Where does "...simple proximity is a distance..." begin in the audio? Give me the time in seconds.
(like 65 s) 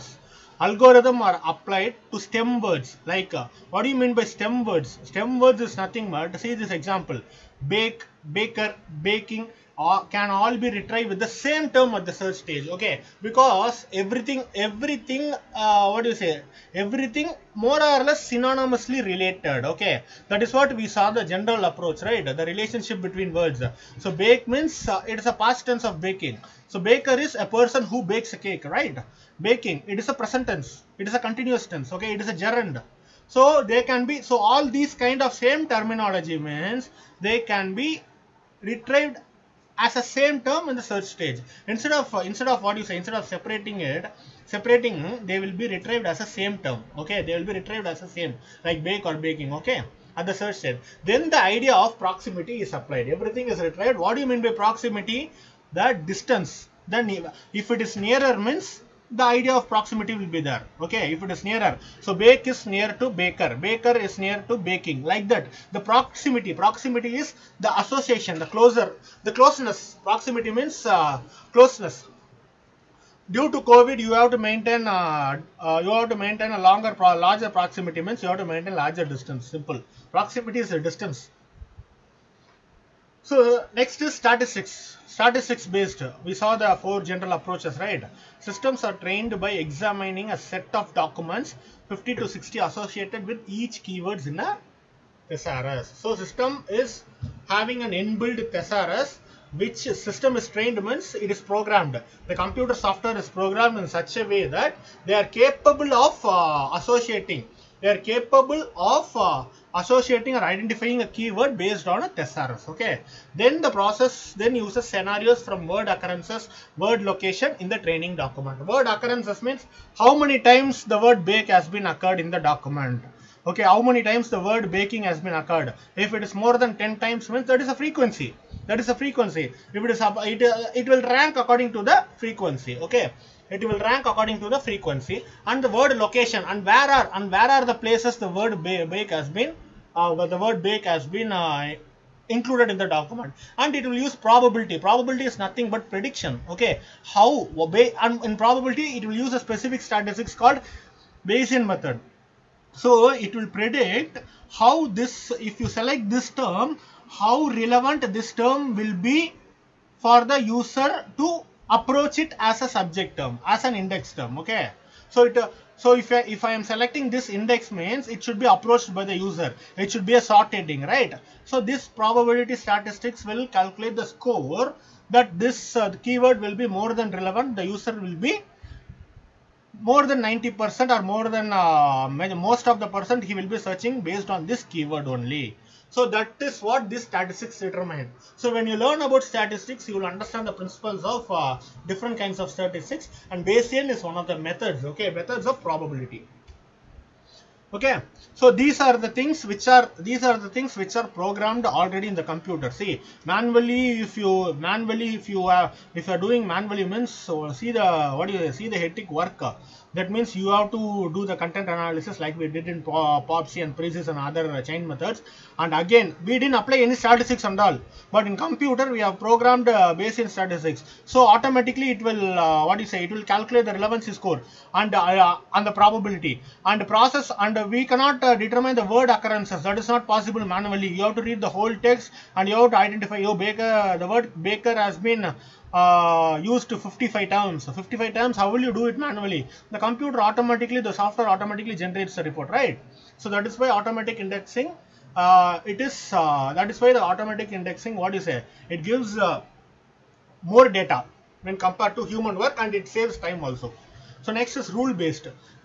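79 s.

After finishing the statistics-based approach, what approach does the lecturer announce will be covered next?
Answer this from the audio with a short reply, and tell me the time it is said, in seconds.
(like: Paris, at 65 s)
Rule based, at 254 s.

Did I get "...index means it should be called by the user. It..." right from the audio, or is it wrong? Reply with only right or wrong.
wrong.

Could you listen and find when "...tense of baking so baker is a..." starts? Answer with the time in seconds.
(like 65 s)
25 s.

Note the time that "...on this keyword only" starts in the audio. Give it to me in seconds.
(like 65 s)
184 s.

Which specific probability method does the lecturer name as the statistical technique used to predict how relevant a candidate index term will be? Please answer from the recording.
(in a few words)
Bayesian method.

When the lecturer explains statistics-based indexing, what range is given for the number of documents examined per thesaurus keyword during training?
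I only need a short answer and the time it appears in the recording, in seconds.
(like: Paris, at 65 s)
50 to 60, at 91 s.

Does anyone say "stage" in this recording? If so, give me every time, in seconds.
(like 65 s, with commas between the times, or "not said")
12 s, 41 s, 50 s.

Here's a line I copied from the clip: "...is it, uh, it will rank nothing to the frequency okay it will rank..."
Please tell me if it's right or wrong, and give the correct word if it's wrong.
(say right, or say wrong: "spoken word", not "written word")
wrong: "according", not "nothing".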